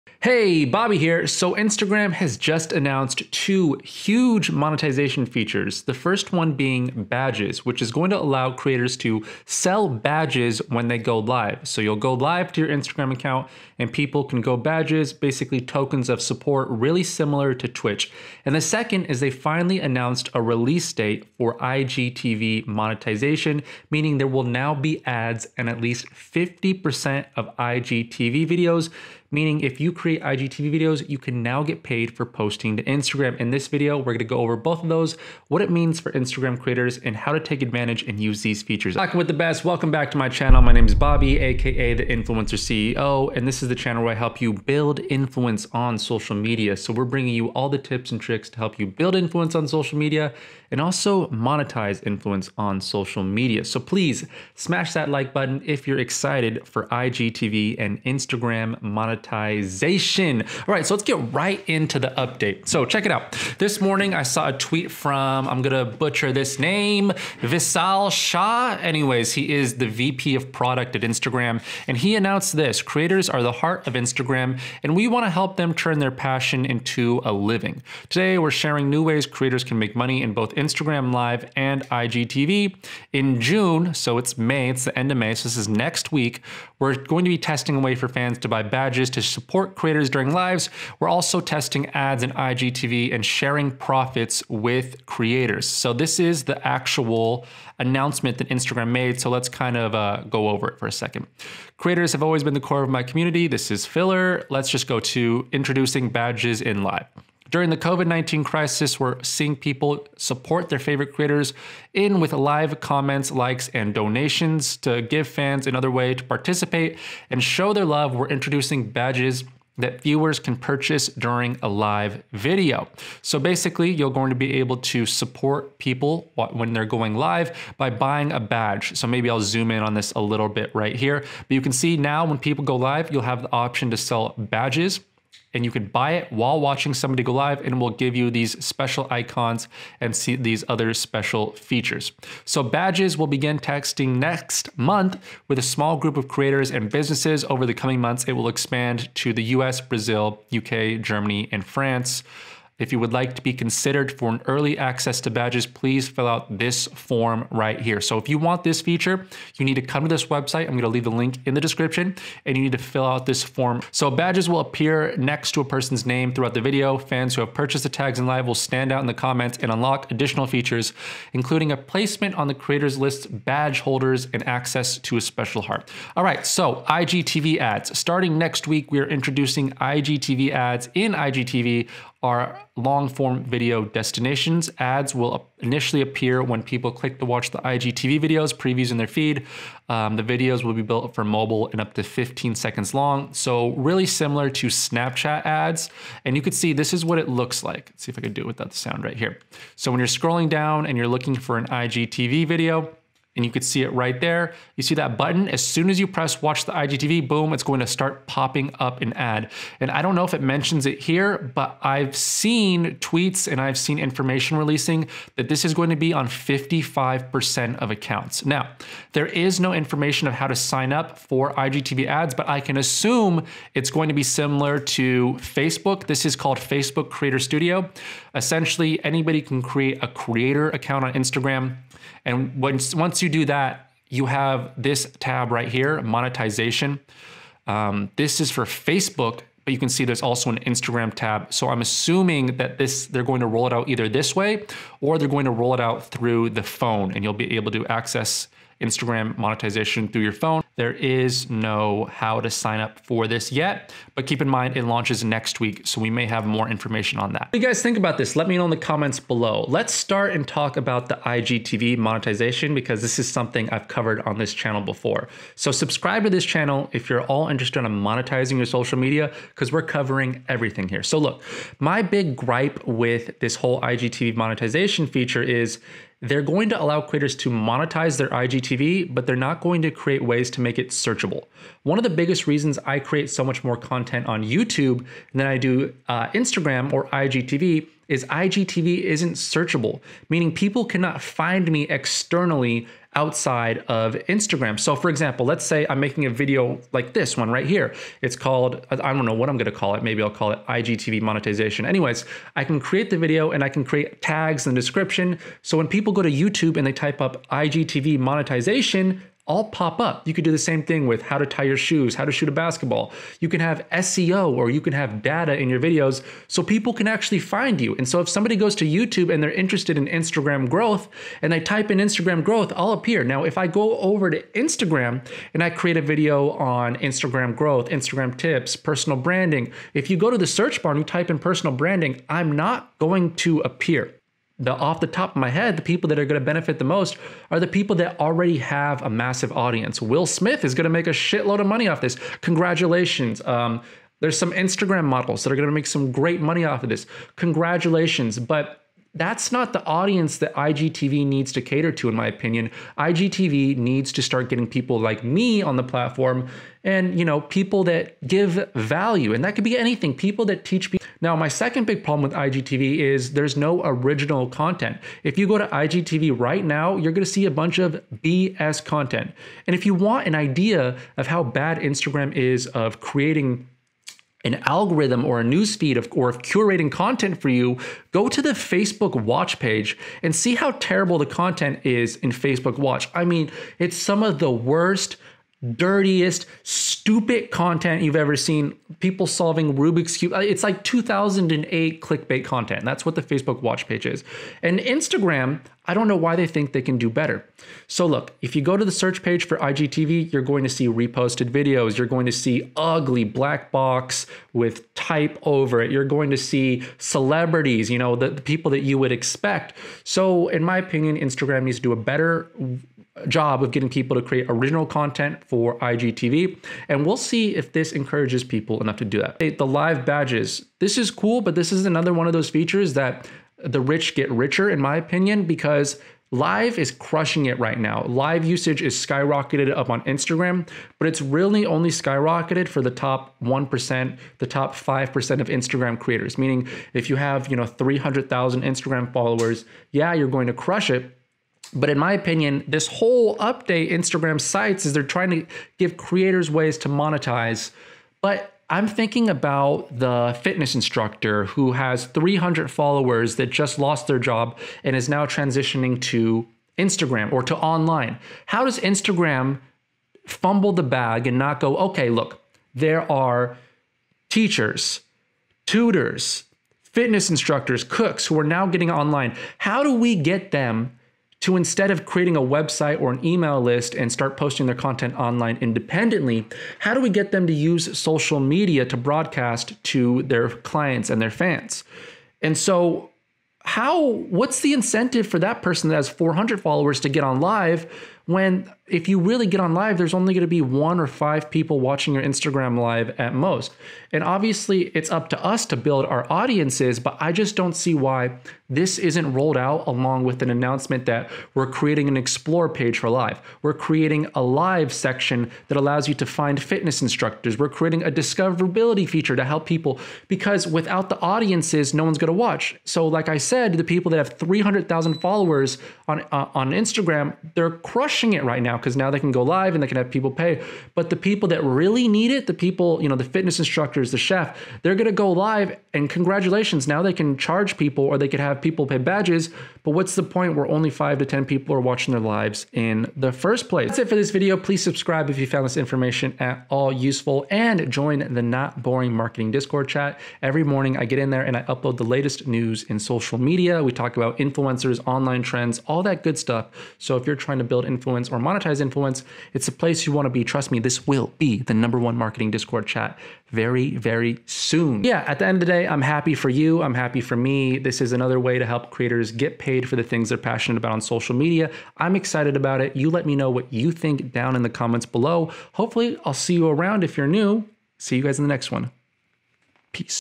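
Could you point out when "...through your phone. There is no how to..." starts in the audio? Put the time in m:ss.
4:10.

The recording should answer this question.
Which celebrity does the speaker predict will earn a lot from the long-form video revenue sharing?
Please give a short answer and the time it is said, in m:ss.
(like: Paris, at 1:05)
Will Smith, at 5:40.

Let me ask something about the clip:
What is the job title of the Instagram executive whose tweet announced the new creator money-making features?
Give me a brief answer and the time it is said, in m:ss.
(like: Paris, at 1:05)
VP of product, at 1:09.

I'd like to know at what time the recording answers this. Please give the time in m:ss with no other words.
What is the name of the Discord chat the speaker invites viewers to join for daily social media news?
8:58.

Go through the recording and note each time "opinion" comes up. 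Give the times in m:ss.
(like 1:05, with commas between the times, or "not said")
5:52, 6:50, 7:04, 7:22.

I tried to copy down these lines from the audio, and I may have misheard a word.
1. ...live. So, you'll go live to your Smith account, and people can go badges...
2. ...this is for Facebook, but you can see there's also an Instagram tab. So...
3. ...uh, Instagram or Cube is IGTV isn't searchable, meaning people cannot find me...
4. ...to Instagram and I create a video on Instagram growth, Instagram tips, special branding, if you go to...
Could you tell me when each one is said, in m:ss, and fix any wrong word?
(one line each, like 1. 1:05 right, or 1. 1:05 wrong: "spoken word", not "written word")
1. 0:11 wrong: "Instagram", not "Smith"
2. 3:58 right
3. 4:46 wrong: "IGTV", not "Cube"
4. 5:24 wrong: "personal", not "special".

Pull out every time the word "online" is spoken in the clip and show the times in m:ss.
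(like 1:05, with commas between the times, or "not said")
7:37, 7:48, 7:55, 9:05.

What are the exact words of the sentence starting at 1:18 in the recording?
Today we're sharing new ways creators can make money in both Instagram Live and IGTV.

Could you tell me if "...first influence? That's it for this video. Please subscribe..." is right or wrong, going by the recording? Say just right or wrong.
wrong.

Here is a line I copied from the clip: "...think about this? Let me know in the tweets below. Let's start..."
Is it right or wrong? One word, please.
wrong.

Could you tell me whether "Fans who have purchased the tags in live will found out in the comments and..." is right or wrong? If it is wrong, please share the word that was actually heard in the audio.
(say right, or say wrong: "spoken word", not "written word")
wrong: "stand", not "found".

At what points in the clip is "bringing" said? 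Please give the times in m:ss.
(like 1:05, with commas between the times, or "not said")
0:47.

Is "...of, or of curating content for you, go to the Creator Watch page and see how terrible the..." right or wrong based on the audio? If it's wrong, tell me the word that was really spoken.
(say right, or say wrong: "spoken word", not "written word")
wrong: "Facebook", not "Creator".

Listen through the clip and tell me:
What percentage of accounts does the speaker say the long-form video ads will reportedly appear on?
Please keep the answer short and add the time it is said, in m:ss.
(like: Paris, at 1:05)
55%, at 3:36.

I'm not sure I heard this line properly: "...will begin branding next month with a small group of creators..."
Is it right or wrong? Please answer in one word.
wrong.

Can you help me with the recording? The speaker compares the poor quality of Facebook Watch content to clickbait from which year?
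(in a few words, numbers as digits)
2008.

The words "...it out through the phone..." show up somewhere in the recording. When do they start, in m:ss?
4:05.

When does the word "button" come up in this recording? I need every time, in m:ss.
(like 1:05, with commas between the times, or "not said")
0:55, 3:25.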